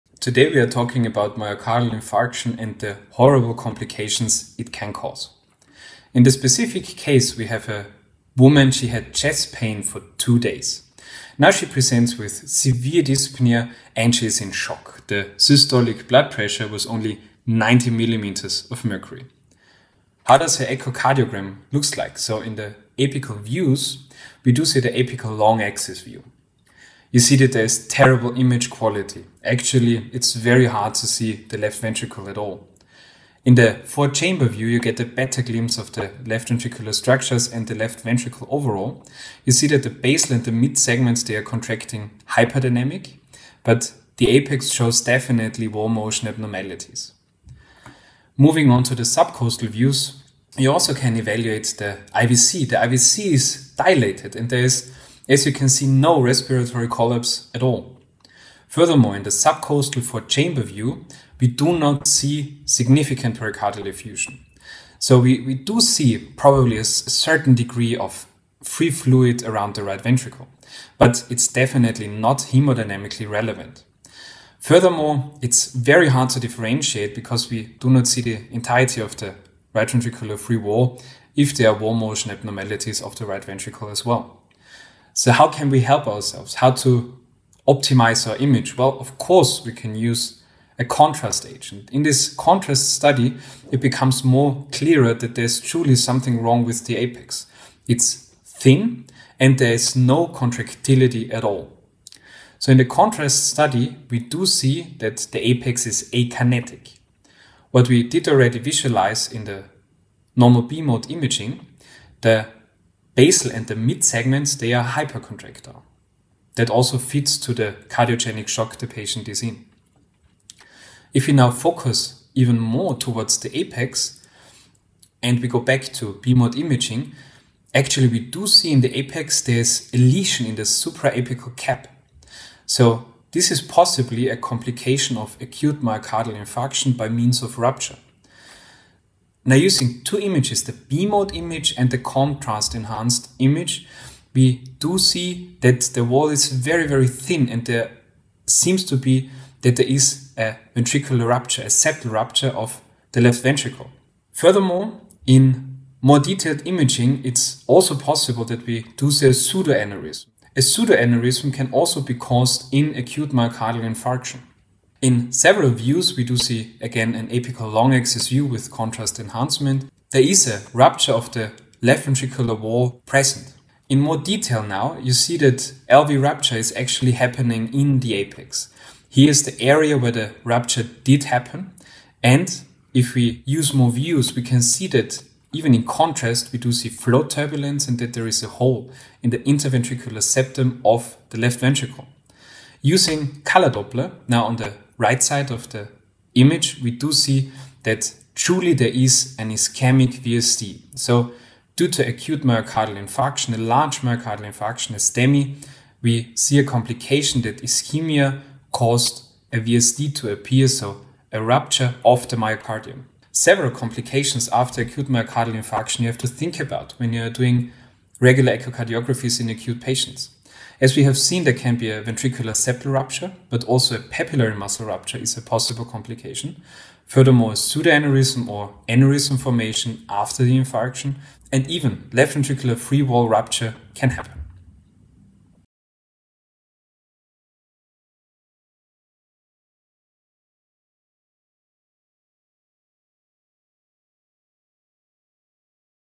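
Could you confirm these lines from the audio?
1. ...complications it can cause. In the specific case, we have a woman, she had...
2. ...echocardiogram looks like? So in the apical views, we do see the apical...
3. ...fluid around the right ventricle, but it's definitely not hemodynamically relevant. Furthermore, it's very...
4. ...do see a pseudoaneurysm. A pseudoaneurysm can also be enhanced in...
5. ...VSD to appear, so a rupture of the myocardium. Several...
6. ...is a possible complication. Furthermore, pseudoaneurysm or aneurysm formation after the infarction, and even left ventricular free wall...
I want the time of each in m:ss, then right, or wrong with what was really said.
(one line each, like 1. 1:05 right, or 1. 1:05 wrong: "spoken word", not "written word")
1. 0:03 right
2. 0:20 right
3. 1:08 right
4. 2:38 wrong: "caused", not "enhanced"
5. 3:29 right
6. 3:45 right.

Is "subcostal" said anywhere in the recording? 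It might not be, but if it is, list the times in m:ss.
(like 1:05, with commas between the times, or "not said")
0:49, 0:59.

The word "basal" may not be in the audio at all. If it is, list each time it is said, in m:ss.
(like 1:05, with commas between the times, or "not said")
0:39, 1:53.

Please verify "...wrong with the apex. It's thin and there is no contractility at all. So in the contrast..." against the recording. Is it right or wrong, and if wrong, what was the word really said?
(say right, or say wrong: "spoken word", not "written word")
right.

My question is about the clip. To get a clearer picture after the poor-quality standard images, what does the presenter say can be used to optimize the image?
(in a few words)
contrast agent.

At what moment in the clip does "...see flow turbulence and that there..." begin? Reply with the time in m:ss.
3:06.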